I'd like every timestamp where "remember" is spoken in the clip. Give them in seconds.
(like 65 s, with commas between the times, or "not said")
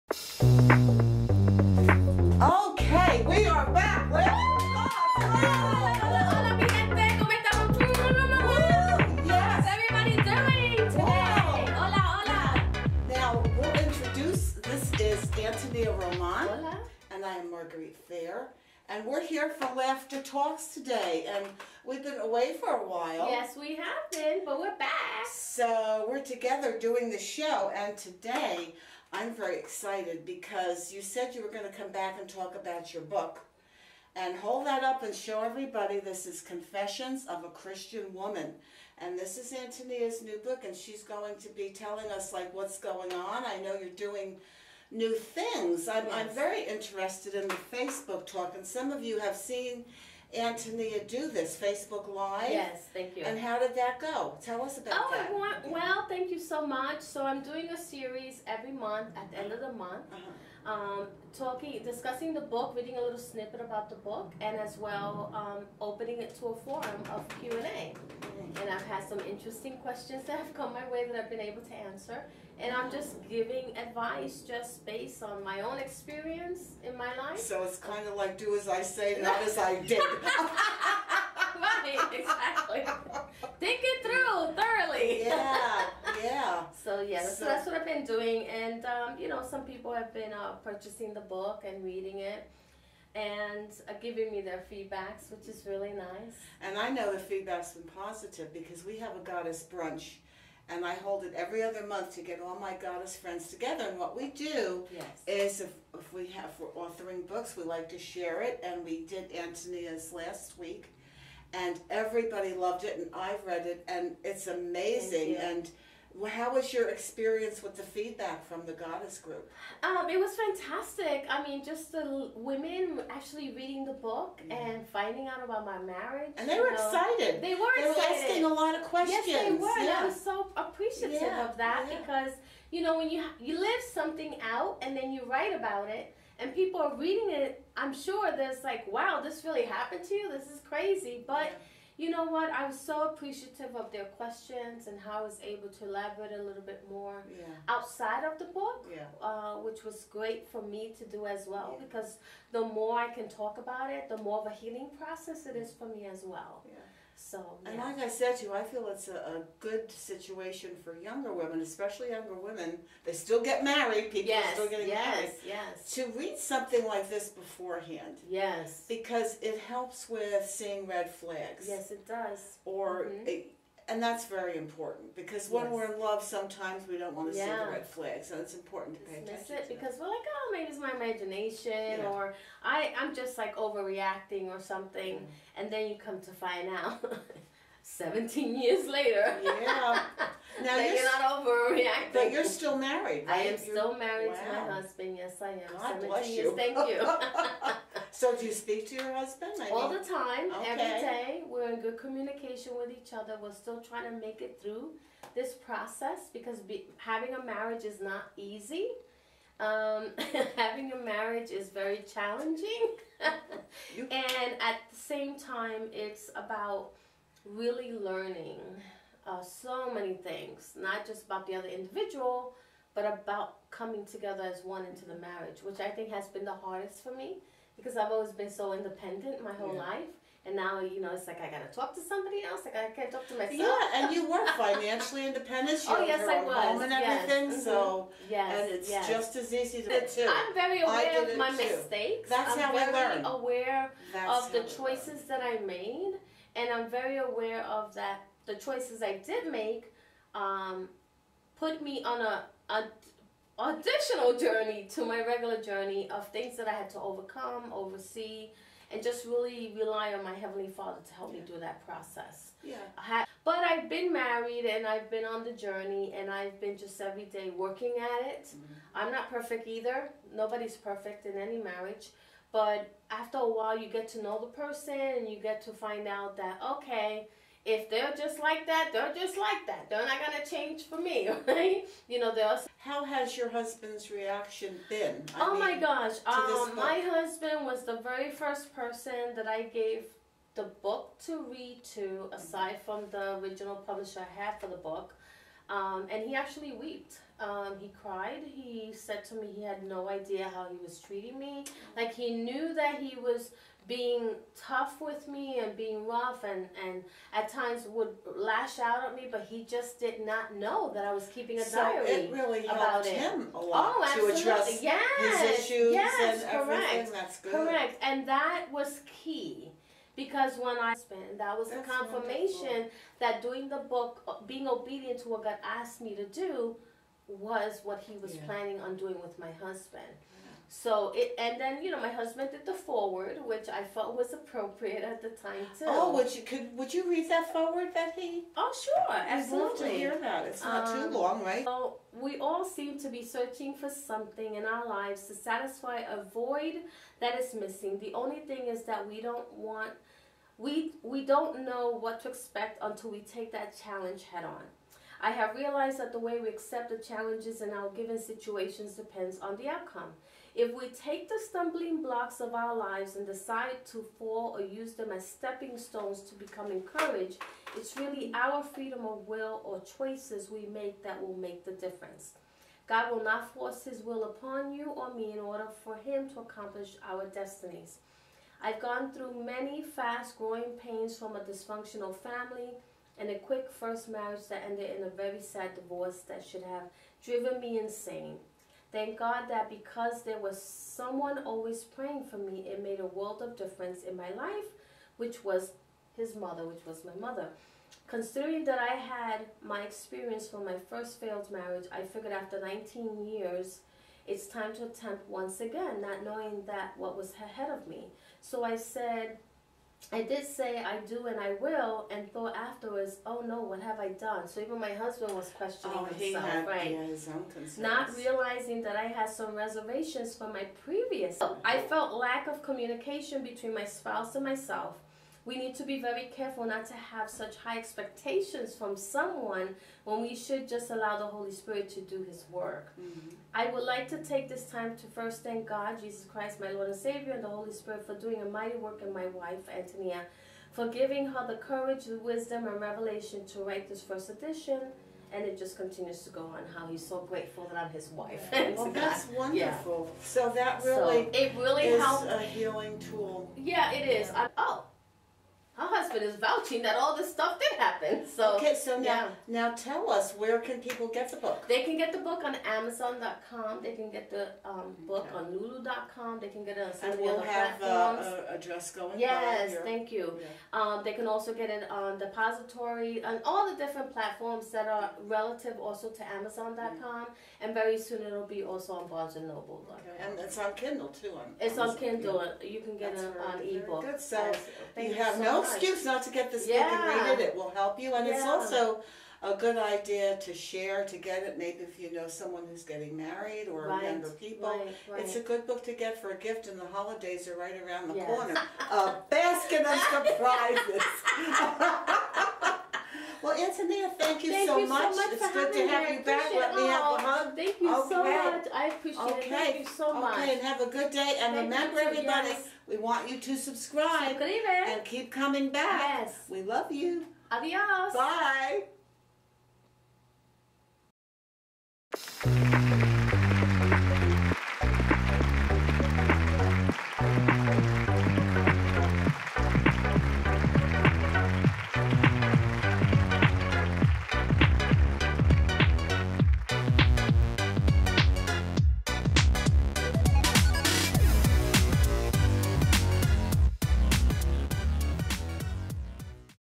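511 s.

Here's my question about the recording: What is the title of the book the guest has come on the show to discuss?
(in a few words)
Confessions of a Christian Woman.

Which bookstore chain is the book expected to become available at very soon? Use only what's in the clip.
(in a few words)
Barnes and Noble.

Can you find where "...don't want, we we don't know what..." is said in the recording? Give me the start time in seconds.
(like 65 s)
349 s.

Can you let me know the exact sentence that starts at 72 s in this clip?
And I'm just giving advice just based on my own experience in my life.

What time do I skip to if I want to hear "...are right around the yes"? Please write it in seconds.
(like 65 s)
497 s.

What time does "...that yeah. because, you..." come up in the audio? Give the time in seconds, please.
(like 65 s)
131 s.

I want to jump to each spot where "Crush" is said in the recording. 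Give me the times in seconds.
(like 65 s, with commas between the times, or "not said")
not said.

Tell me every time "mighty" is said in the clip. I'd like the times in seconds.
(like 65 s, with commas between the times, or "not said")
438 s.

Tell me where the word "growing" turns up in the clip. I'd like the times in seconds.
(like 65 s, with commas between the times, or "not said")
380 s.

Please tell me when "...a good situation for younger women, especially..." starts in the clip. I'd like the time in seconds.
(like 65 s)
159 s.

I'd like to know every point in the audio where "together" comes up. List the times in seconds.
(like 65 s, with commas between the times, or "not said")
26 s, 103 s, 224 s.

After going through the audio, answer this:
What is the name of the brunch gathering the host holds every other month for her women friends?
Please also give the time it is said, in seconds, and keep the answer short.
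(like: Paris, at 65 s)
Goddess brunch, at 99 s.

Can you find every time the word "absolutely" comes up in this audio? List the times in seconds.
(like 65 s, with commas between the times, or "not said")
314 s, 339 s.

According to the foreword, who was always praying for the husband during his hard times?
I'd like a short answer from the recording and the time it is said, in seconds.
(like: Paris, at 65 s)
His mother, at 397 s.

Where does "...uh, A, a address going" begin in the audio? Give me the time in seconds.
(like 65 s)
467 s.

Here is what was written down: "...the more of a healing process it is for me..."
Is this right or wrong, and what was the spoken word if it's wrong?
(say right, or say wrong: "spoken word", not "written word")
right.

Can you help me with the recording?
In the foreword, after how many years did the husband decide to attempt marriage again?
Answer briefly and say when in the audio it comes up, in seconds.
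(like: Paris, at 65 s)
19, at 402 s.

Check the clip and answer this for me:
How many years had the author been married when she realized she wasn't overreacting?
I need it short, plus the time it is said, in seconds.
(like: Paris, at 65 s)
17, at 187 s.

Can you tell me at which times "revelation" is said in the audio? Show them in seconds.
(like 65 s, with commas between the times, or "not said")
442 s.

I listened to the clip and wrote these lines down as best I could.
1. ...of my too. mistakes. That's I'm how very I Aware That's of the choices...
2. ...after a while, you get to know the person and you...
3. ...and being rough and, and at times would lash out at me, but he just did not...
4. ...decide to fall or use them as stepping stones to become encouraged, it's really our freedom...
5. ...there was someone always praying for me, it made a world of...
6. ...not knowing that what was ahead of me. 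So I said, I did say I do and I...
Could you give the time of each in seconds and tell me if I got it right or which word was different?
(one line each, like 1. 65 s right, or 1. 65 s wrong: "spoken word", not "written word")
1. 241 s right
2. 273 s right
3. 305 s right
4. 363 s right
5. 390 s right
6. 406 s right.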